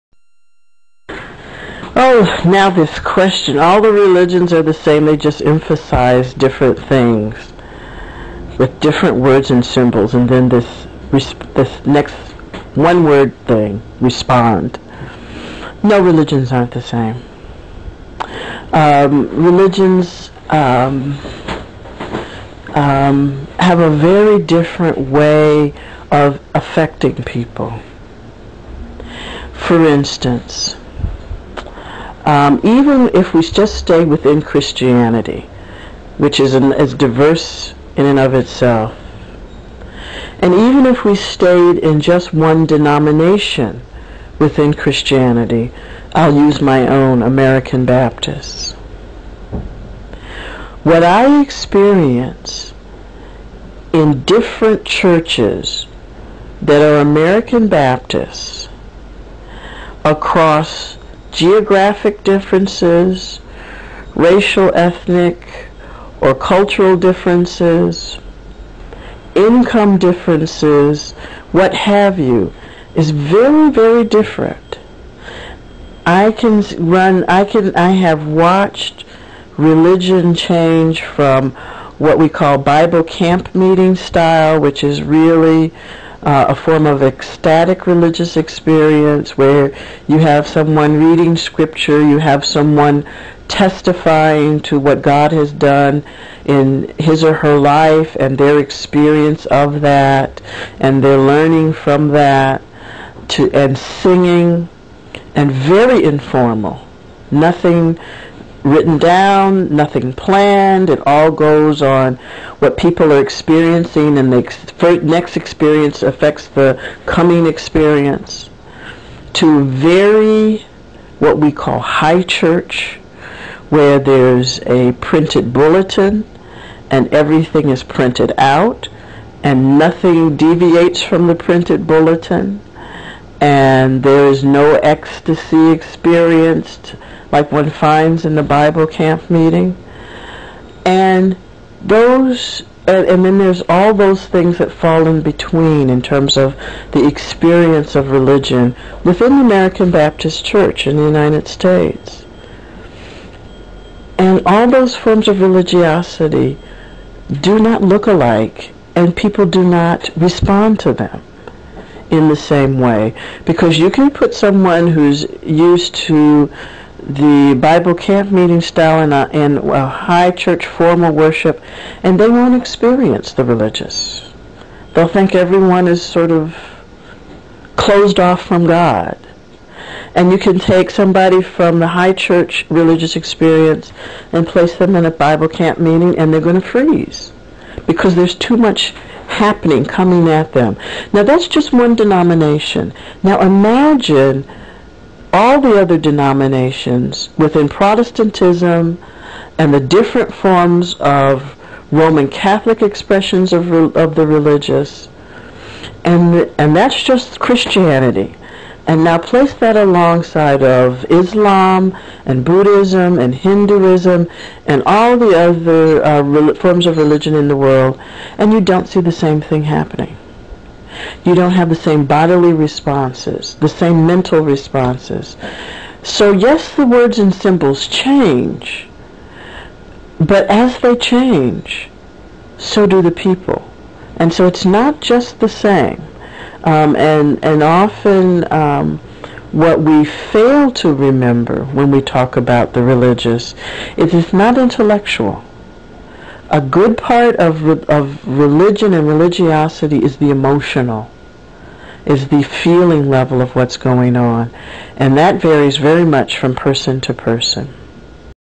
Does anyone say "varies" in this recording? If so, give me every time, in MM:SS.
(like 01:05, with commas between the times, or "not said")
04:15.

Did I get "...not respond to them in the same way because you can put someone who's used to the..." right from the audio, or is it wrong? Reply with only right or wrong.
right.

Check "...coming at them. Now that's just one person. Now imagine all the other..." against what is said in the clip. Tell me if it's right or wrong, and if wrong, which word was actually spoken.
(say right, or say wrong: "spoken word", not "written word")
wrong: "denomination", not "person".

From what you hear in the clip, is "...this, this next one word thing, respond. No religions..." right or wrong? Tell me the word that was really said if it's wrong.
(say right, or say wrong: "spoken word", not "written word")
right.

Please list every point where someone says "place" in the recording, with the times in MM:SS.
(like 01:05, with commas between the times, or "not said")
03:04, 03:29.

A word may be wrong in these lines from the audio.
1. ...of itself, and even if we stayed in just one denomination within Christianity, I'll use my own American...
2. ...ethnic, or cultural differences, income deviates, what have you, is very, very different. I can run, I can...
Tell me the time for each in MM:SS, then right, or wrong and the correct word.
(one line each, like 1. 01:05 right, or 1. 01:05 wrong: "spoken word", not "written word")
1. 00:38 right
2. 01:04 wrong: "differences", not "deviates".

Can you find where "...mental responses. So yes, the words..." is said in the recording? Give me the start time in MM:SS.
03:44.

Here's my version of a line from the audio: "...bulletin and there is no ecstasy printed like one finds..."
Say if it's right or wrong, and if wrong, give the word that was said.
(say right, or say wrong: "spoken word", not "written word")
wrong: "experienced", not "printed".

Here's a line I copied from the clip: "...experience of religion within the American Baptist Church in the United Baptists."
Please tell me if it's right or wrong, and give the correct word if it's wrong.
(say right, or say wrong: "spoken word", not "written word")
wrong: "States", not "Baptists".